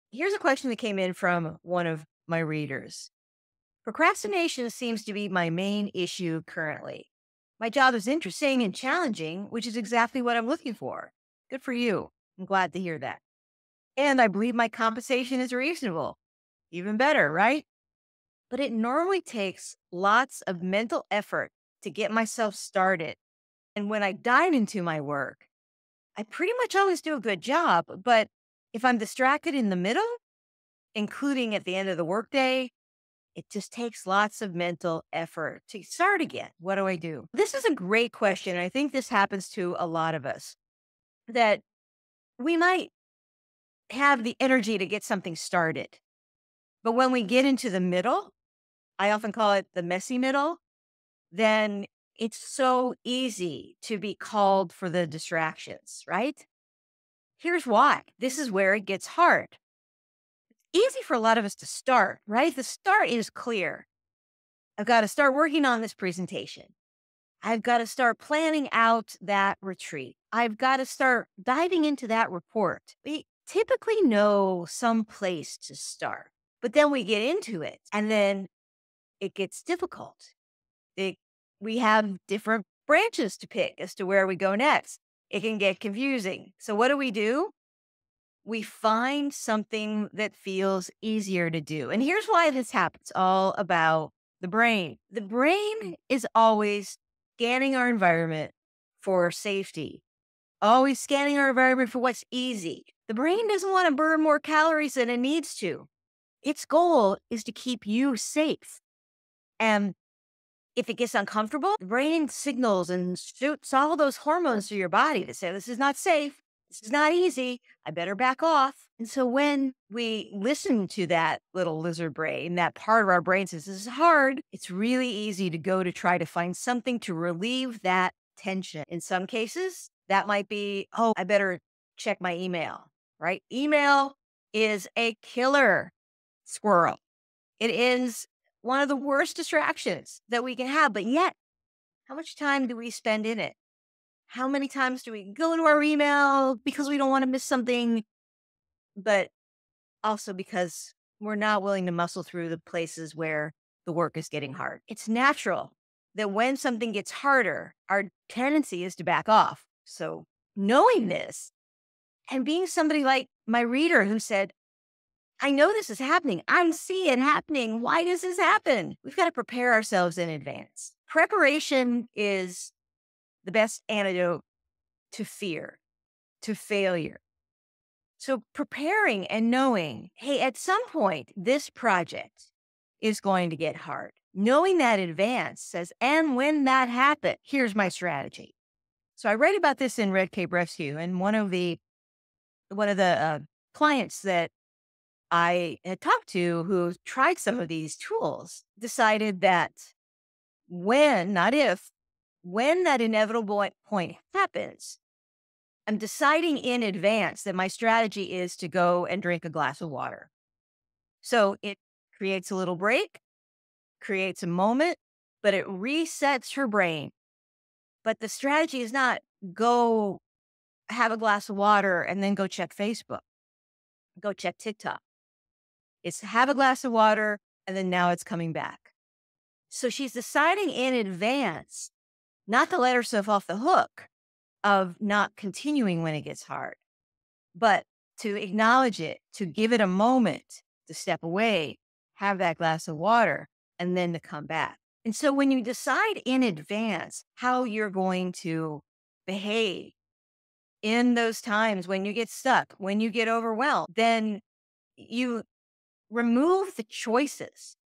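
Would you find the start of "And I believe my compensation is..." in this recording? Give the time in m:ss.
0:13.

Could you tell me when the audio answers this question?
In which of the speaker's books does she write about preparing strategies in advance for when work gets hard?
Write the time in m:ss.
3:10.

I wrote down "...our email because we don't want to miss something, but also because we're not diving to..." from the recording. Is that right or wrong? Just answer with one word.
wrong.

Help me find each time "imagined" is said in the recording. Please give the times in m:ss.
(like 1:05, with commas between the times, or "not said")
not said.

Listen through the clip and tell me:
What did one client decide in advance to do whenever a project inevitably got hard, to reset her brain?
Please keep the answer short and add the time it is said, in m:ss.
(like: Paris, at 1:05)
Drink a glass of water, at 3:29.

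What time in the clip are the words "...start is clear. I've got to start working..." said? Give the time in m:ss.
1:02.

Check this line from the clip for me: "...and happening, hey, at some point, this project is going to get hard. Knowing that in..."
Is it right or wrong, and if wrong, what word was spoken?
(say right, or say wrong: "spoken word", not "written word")
wrong: "knowing", not "happening".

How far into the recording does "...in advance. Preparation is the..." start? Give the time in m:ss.
2:50.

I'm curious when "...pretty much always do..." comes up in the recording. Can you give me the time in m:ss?
0:26.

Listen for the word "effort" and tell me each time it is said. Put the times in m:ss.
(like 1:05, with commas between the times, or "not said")
0:21, 0:35.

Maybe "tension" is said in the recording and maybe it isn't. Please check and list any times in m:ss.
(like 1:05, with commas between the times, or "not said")
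2:08.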